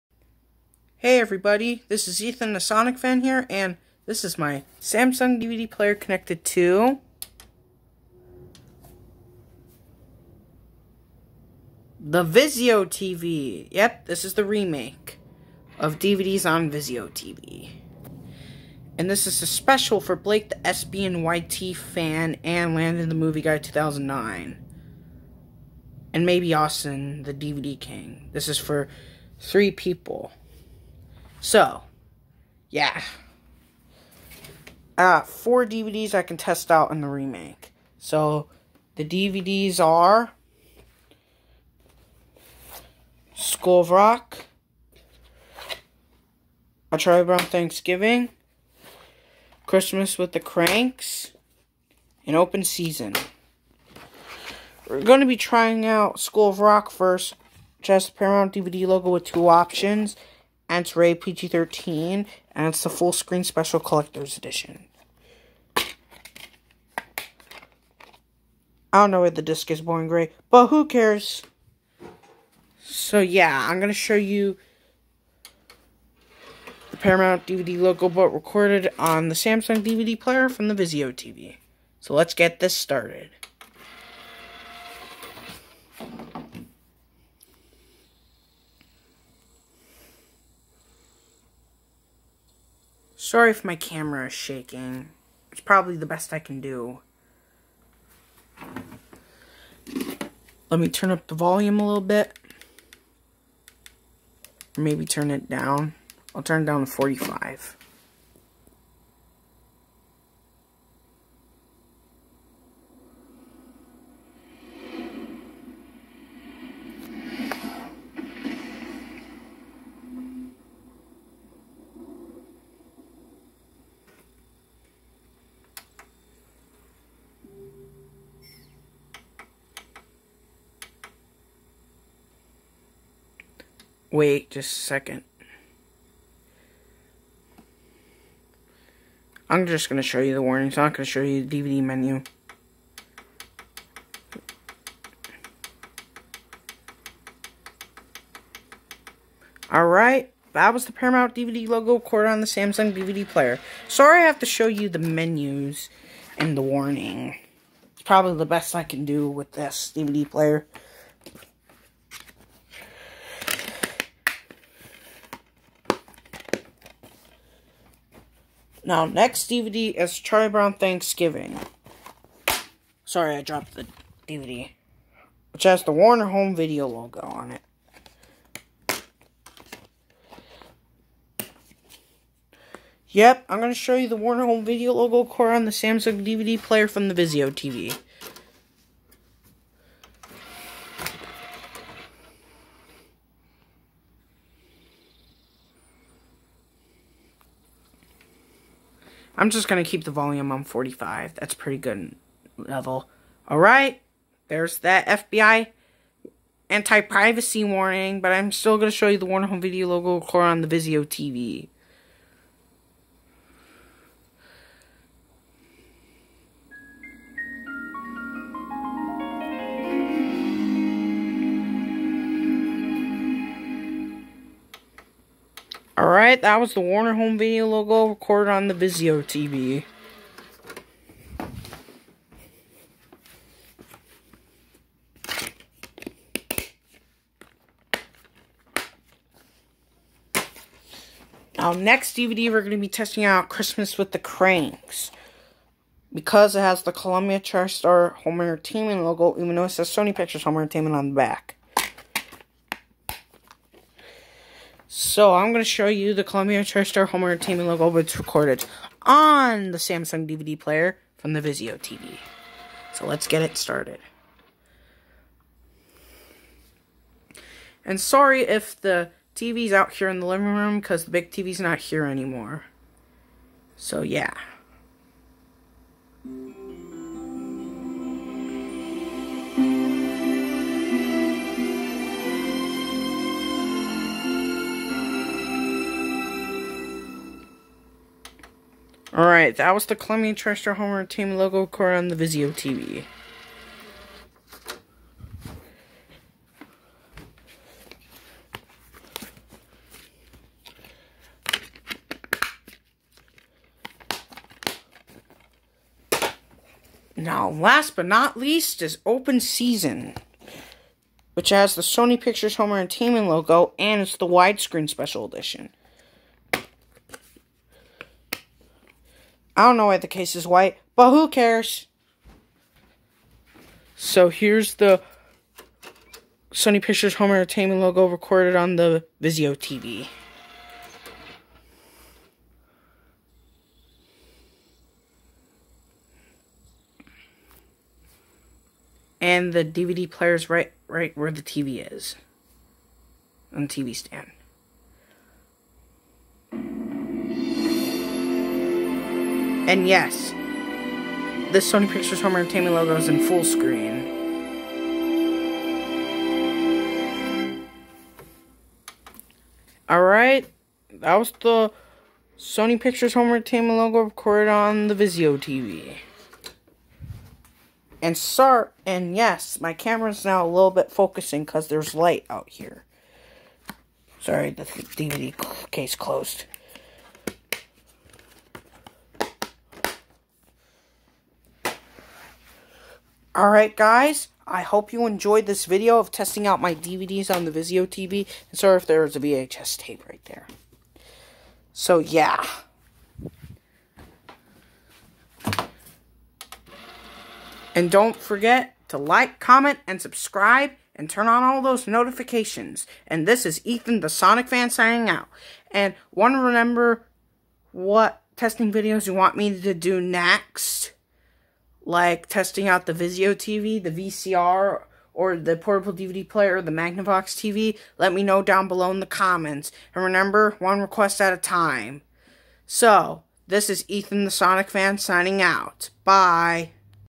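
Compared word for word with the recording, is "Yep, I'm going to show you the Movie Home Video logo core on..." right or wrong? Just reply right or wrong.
wrong.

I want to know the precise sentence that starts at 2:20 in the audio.
I'm not going to show you the DVD menu.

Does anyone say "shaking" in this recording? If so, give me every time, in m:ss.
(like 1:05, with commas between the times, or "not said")
1:34.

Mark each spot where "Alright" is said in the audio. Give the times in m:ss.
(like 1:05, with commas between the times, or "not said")
2:29, 4:49, 5:59, 6:23.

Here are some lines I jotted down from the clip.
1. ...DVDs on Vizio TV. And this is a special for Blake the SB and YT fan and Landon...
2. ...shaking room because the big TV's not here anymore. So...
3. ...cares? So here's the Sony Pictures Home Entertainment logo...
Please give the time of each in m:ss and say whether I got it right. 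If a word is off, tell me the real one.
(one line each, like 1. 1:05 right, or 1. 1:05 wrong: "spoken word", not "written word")
1. 0:15 right
2. 4:30 wrong: "living", not "shaking"
3. 5:21 right.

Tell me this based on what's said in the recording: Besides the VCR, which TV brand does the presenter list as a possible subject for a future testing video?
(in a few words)
Magnavox.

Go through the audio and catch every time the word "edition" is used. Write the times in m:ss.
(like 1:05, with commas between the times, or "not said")
1:04, 5:15.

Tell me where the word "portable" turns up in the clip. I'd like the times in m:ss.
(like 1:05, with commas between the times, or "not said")
6:55.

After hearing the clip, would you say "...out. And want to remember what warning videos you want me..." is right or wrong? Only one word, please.
wrong.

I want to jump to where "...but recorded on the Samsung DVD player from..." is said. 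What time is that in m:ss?
1:18.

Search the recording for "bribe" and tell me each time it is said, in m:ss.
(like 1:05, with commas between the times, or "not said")
not said.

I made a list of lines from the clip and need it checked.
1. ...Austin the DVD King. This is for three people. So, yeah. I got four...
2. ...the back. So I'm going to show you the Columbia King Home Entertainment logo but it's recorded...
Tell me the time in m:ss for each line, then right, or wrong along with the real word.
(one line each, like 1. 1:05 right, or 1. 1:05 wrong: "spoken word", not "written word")
1. 0:26 right
2. 4:11 wrong: "TriStar", not "King".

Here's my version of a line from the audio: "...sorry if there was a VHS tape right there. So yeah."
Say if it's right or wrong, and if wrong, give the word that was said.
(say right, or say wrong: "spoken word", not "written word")
right.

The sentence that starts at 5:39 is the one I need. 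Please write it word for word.
And the DVD player is right right where the TV is.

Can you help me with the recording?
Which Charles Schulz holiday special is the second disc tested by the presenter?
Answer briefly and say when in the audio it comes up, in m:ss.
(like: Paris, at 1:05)
A Charlie Brown Thanksgiving, at 0:46.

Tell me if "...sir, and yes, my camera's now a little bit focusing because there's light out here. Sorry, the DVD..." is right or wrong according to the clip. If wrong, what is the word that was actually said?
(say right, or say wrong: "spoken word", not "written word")
right.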